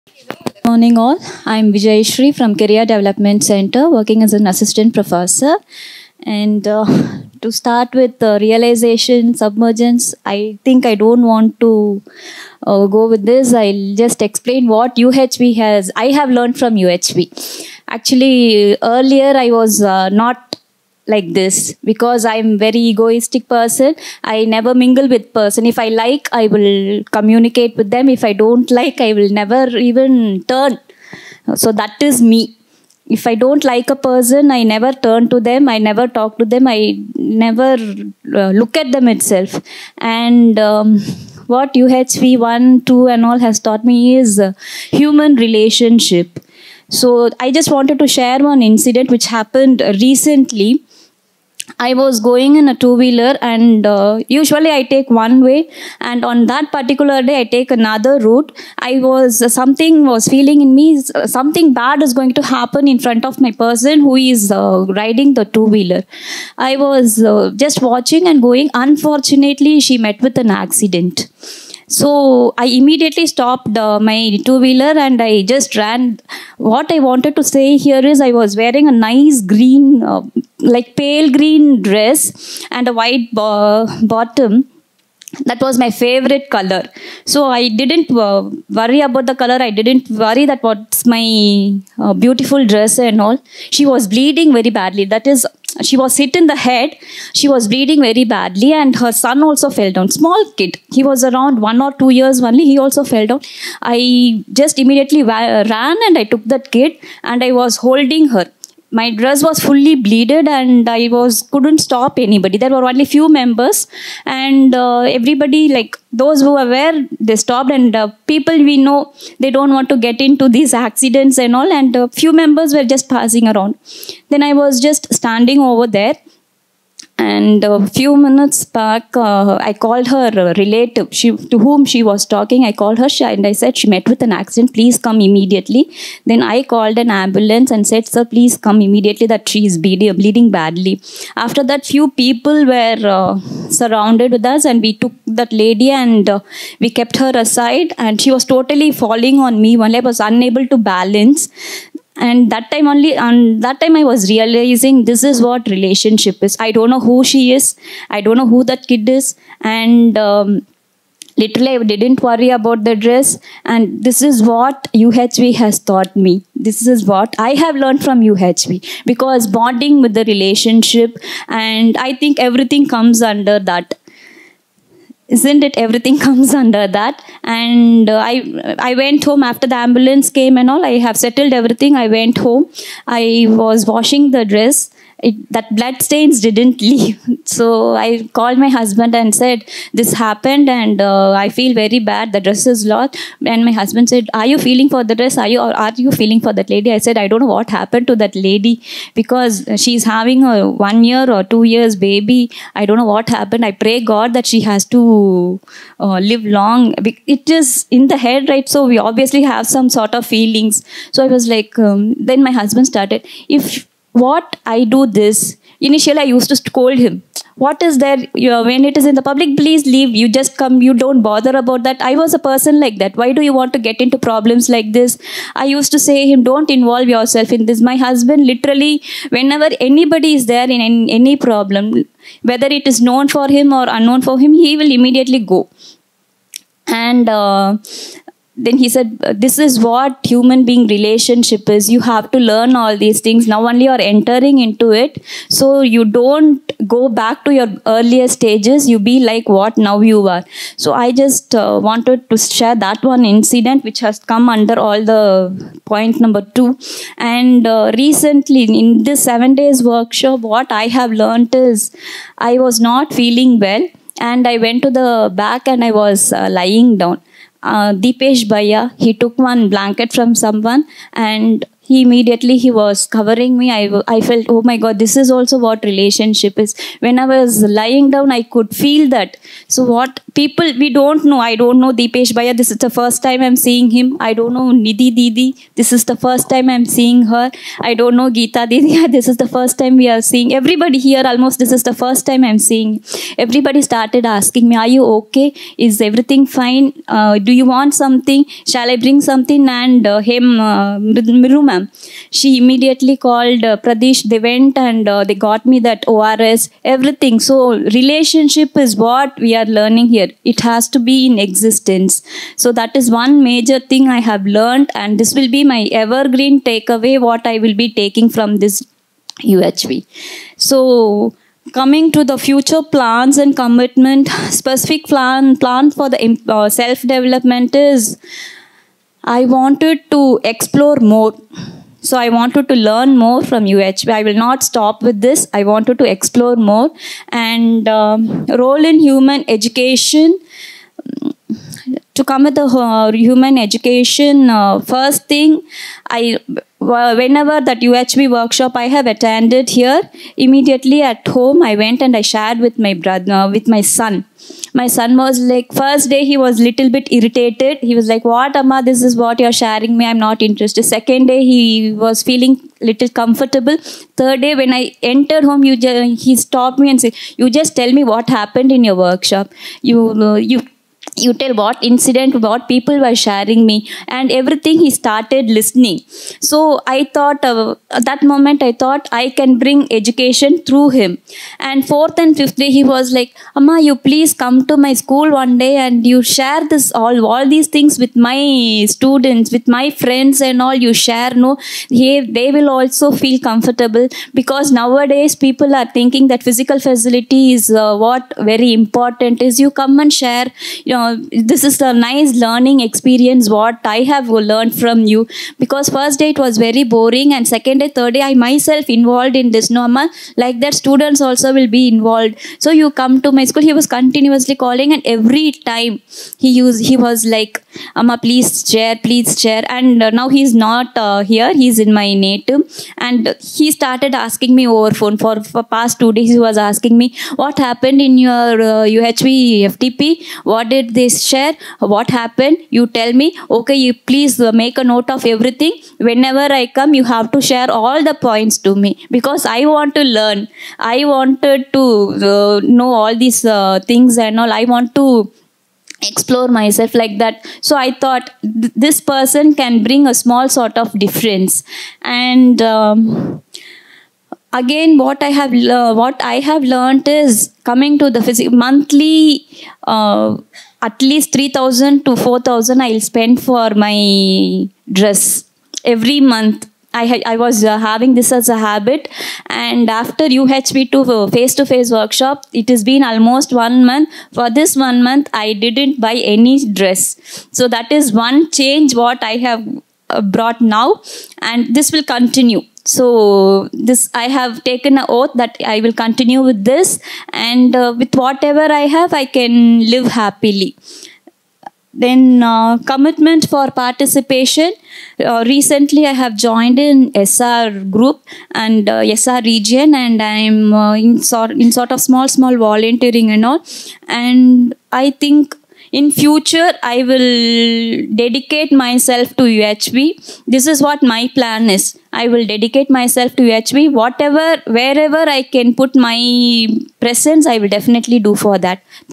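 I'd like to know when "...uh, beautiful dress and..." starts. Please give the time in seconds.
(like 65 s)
92 s.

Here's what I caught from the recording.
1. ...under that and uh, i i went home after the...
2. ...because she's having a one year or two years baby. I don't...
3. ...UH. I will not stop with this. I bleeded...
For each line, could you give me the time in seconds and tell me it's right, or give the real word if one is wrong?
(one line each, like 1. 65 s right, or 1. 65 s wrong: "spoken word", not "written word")
1. 176 s right
2. 199 s right
3. 333 s wrong: "wanted", not "bleeded".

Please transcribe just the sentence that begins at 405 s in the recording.
Because first day it was very boring and second day, third day I myself involved in this.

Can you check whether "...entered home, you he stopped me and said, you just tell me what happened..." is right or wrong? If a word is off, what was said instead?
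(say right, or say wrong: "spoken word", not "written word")
right.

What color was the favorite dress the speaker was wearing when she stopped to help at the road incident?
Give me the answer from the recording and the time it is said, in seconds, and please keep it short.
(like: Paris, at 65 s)
pale green, at 80 s.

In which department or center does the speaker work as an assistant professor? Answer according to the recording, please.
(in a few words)
Career Development Center.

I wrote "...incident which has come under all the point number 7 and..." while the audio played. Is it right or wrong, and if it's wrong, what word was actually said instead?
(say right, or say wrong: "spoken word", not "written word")
wrong: "2", not "7".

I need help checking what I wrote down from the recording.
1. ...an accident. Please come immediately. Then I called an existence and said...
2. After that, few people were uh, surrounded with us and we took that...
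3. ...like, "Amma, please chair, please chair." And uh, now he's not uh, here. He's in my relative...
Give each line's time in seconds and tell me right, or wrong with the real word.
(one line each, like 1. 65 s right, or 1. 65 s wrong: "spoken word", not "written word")
1. 134 s wrong: "ambulance", not "existence"
2. 141 s right
3. 417 s wrong: "native", not "relative".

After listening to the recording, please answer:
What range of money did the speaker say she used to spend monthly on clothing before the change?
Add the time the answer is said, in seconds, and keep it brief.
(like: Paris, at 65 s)
3000 to 4000, at 461 s.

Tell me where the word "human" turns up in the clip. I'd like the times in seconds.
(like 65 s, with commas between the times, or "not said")
44 s, 240 s, 338 s, 343 s.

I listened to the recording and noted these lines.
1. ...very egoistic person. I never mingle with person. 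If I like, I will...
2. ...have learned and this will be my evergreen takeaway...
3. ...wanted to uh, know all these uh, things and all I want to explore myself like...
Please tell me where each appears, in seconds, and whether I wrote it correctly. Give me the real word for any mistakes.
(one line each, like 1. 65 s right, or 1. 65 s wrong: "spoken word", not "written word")
1. 22 s right
2. 314 s right
3. 441 s right.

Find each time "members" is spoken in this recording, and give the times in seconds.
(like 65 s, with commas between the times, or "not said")
113 s, 122 s.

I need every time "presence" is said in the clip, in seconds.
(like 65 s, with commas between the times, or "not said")
517 s.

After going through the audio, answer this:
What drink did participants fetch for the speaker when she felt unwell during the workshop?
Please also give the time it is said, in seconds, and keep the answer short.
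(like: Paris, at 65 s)
ORS, at 306 s.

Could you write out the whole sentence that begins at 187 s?
So I called my husband and said, this happened and uh, I feel very bad.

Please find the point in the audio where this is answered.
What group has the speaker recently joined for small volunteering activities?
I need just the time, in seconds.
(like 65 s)
497 s.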